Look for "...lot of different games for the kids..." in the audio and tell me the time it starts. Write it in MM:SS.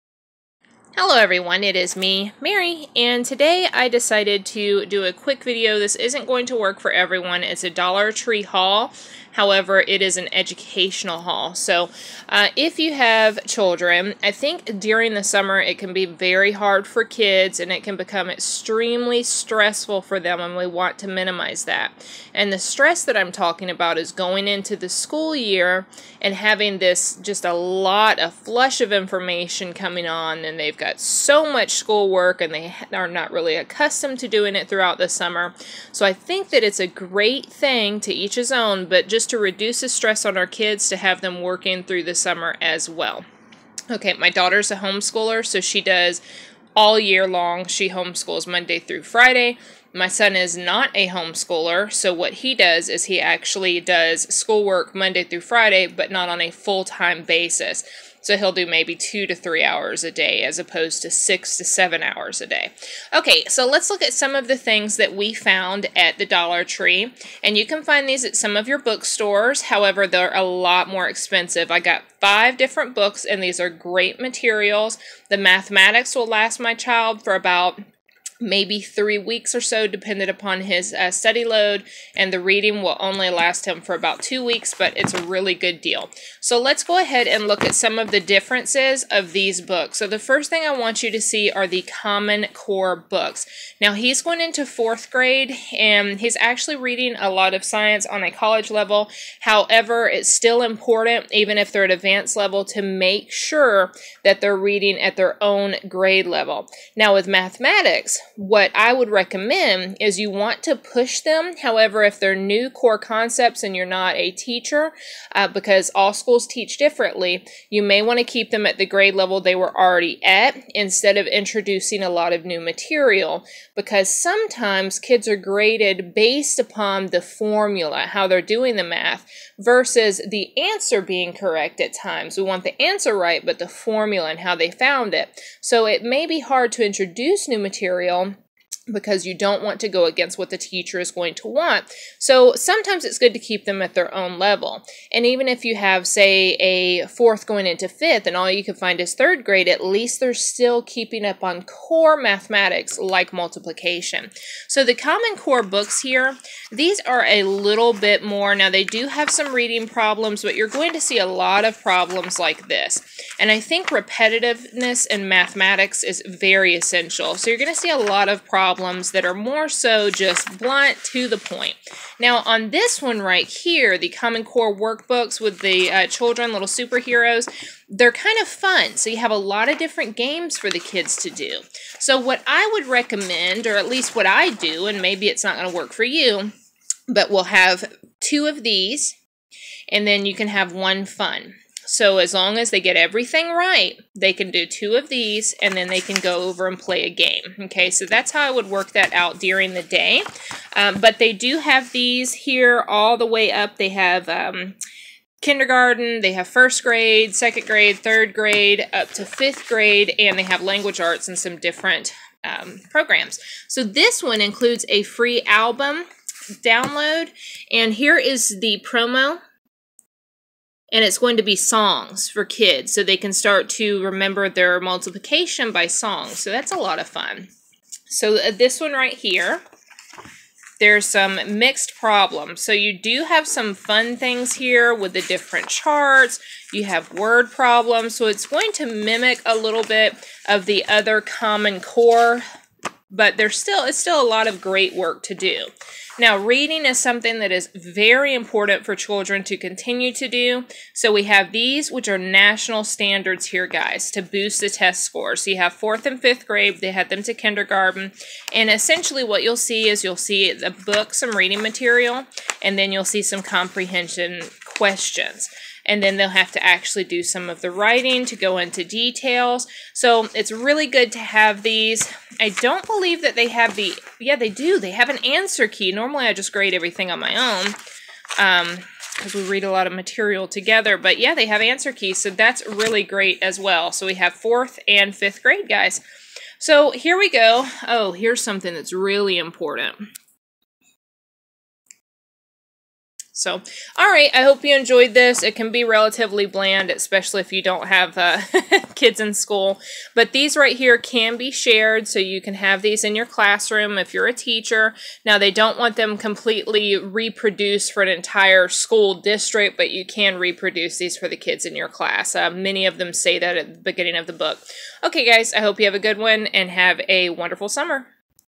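02:59.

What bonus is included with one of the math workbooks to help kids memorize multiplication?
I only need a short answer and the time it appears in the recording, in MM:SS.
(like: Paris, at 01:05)
free album download, at 03:35.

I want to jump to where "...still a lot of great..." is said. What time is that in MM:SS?
04:03.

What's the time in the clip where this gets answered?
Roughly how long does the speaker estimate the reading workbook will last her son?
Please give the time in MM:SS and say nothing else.
01:23.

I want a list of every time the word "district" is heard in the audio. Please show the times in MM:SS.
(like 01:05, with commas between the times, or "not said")
05:09.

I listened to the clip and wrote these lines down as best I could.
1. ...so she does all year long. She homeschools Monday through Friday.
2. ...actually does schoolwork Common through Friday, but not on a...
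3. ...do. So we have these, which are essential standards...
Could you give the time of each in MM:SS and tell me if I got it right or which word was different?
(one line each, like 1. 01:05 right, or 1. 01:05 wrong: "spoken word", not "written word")
1. 00:45 right
2. 00:53 wrong: "Monday", not "Common"
3. 04:10 wrong: "national", not "essential".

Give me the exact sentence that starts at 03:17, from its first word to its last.
Okay, so that's how I would work that out during the day.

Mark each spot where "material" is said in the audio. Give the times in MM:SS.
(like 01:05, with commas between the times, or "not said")
01:14, 02:02, 02:17, 04:21, 04:39.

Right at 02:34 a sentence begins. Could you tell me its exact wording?
So the Common Core books here, these are a little bit more.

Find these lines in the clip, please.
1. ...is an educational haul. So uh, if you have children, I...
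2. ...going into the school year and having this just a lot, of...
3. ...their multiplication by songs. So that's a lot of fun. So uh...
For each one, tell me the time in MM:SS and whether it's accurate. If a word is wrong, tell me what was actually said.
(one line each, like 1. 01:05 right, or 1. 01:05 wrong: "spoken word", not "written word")
1. 00:10 right
2. 00:24 right
3. 03:44 right.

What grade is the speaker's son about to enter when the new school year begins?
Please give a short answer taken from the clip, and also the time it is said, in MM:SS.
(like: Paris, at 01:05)
fourth grade, at 01:34.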